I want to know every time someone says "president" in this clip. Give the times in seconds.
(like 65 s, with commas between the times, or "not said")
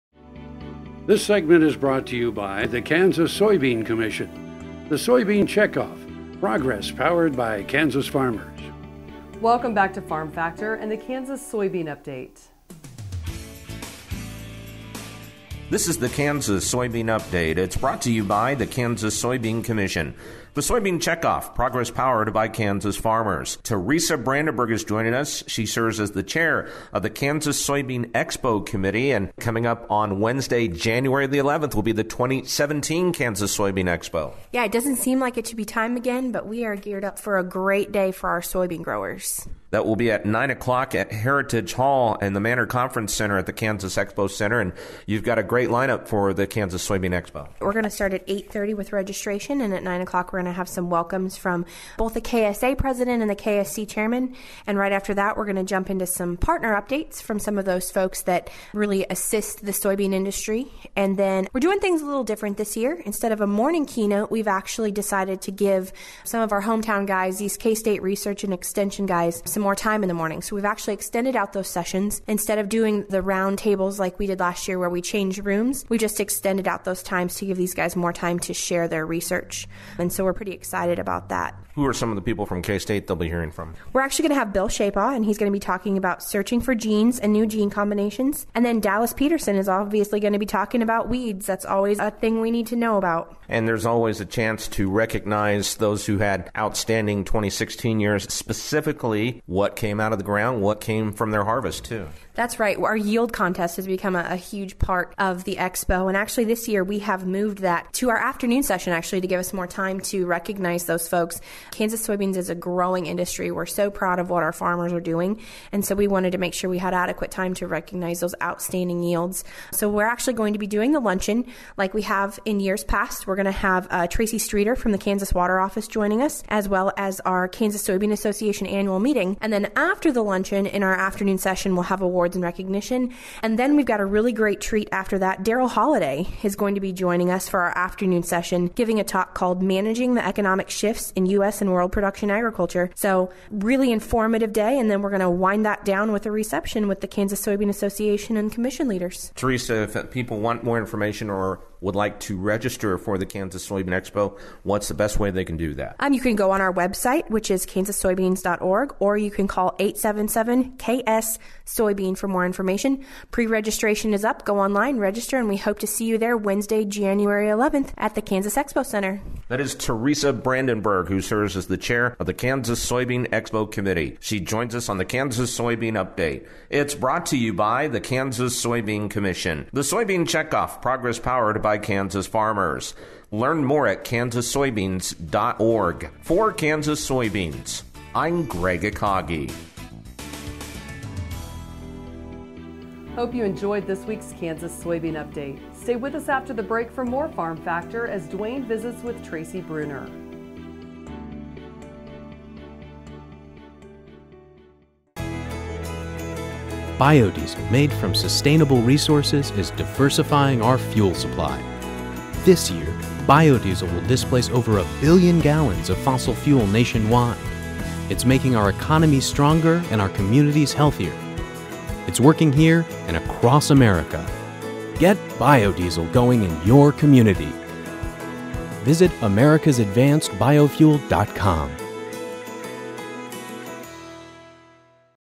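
52 s.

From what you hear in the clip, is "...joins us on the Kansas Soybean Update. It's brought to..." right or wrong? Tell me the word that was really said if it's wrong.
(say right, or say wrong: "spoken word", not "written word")
right.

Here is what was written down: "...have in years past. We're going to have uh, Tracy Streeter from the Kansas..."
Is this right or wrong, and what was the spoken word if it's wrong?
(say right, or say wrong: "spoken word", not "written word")
right.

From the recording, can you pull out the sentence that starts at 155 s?
Um, you can go on our website, which is kansassoybeans.org, or you can call 877 KS Soybean for more information.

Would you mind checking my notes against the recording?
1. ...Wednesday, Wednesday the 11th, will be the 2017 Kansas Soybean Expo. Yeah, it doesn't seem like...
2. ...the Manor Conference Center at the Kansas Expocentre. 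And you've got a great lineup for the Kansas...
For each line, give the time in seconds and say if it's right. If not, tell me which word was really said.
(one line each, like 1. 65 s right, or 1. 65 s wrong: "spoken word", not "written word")
1. 30 s wrong: "January", not "Wednesday"
2. 42 s right.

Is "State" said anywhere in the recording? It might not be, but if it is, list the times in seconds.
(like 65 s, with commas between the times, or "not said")
67 s, 82 s.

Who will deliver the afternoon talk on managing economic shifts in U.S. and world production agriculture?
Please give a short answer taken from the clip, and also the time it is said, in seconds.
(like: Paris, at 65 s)
Darrell Holaday, at 135 s.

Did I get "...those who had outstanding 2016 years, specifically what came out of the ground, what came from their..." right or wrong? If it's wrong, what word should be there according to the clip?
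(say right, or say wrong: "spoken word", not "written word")
right.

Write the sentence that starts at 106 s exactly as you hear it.
And actually, this year we have moved that to our afternoon session, actually, to give us more time to recognize those folks.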